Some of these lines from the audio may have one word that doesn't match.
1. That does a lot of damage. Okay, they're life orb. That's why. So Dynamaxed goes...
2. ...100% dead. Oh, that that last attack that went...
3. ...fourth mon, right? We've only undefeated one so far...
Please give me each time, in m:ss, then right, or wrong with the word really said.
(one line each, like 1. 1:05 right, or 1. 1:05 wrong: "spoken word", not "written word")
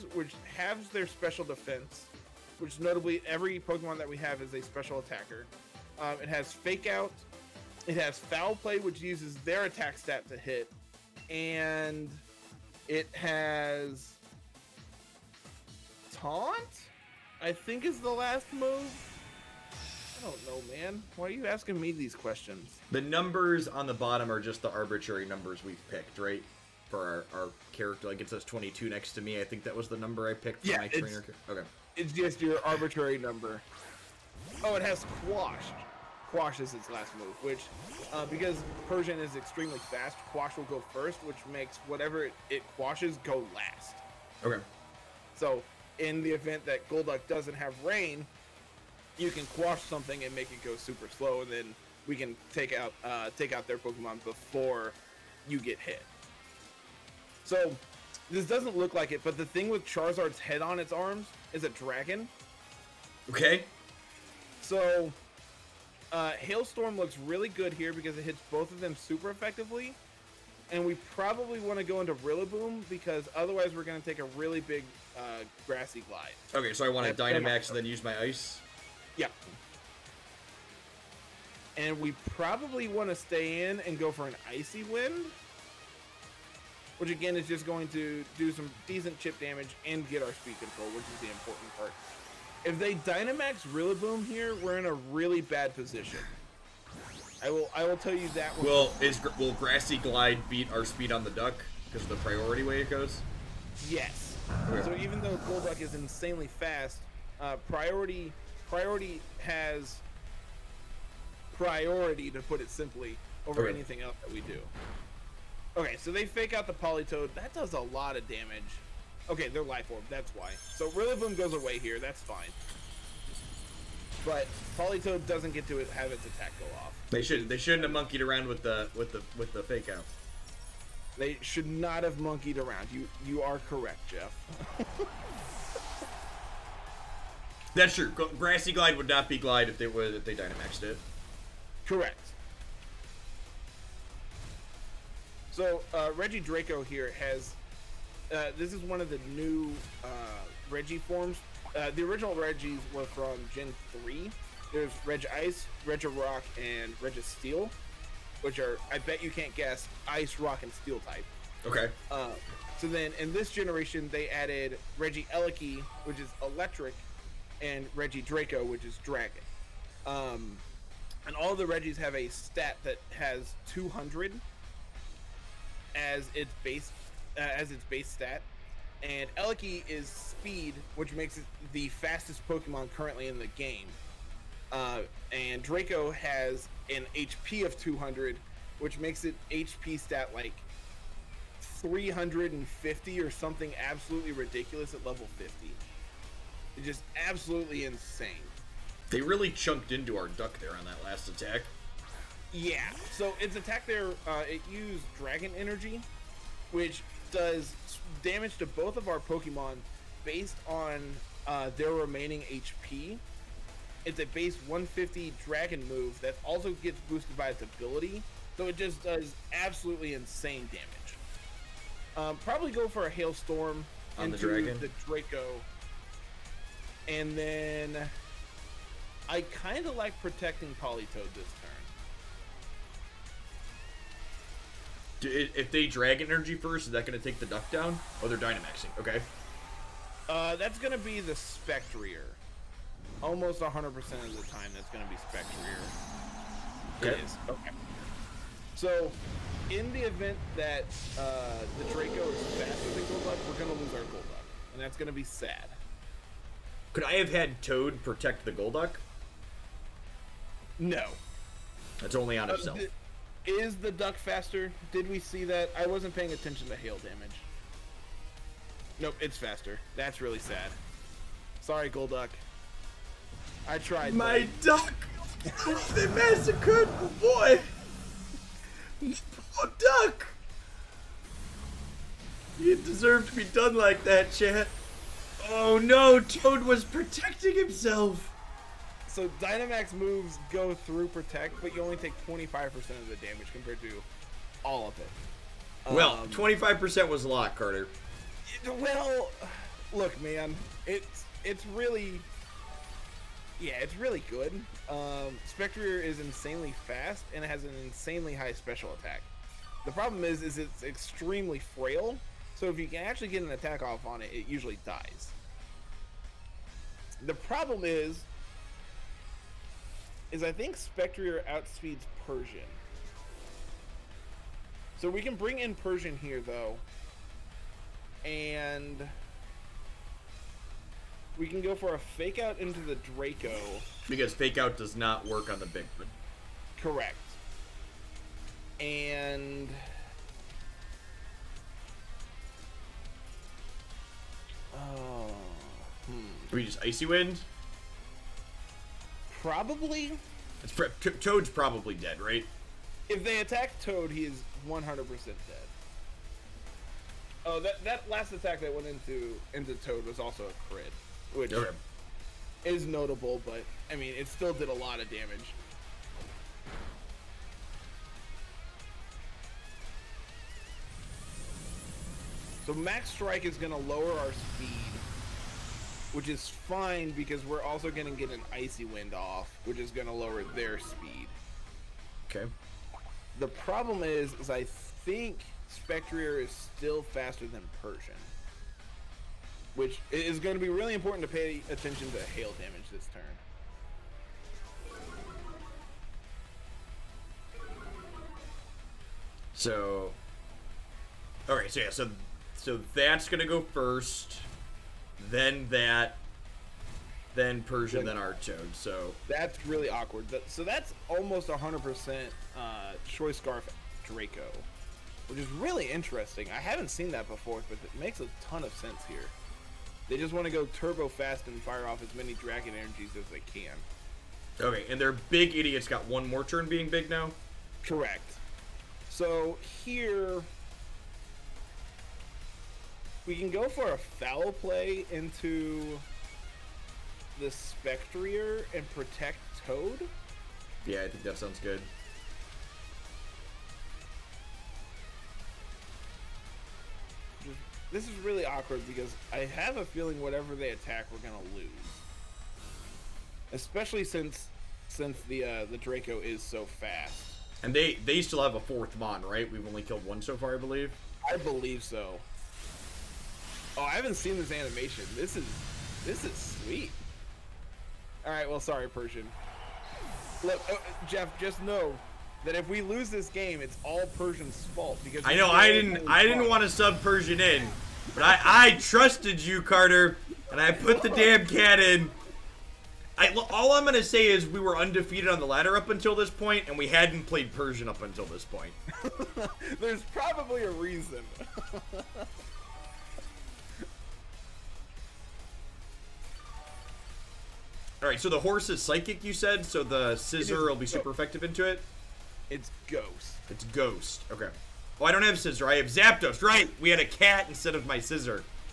1. 1:57 wrong: "Rillaboom", not "Dynamaxed"
2. 5:54 right
3. 7:38 wrong: "killed", not "undefeated".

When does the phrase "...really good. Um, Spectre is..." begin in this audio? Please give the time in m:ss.
5:03.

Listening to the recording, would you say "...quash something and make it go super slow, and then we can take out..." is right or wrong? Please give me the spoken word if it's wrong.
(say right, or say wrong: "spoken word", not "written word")
right.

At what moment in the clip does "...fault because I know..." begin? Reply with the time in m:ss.
7:54.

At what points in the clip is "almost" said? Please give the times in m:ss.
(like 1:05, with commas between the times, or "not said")
4:03, 6:51.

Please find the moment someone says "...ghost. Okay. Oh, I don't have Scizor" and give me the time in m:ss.
8:23.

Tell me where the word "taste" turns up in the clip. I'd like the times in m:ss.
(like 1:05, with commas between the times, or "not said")
not said.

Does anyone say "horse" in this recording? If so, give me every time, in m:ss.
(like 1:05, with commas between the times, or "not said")
8:18.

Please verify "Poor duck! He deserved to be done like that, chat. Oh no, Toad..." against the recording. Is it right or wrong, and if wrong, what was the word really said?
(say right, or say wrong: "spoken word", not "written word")
right.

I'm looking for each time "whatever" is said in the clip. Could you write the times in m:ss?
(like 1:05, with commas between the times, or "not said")
0:41, 7:30.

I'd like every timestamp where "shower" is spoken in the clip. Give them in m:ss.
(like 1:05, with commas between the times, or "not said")
not said.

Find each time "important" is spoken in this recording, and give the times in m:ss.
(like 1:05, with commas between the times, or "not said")
1:31, 6:30.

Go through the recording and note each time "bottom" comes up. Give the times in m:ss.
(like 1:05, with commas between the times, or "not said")
0:23.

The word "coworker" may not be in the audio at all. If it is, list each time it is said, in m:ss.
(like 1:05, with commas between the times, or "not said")
not said.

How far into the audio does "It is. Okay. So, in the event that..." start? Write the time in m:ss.
4:07.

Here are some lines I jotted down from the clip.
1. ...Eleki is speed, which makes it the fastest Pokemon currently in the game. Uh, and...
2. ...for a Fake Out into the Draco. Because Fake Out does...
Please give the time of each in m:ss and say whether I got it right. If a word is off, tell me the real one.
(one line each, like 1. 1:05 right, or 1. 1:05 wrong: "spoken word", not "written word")
1. 2:59 right
2. 5:31 right.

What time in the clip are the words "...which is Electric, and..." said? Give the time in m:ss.
2:46.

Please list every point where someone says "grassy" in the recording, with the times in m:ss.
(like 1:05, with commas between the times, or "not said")
1:15, 1:39, 2:18.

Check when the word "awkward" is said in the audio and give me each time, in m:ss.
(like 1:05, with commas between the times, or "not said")
6:49, 7:28.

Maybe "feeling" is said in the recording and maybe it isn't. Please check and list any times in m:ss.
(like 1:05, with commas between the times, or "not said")
7:29.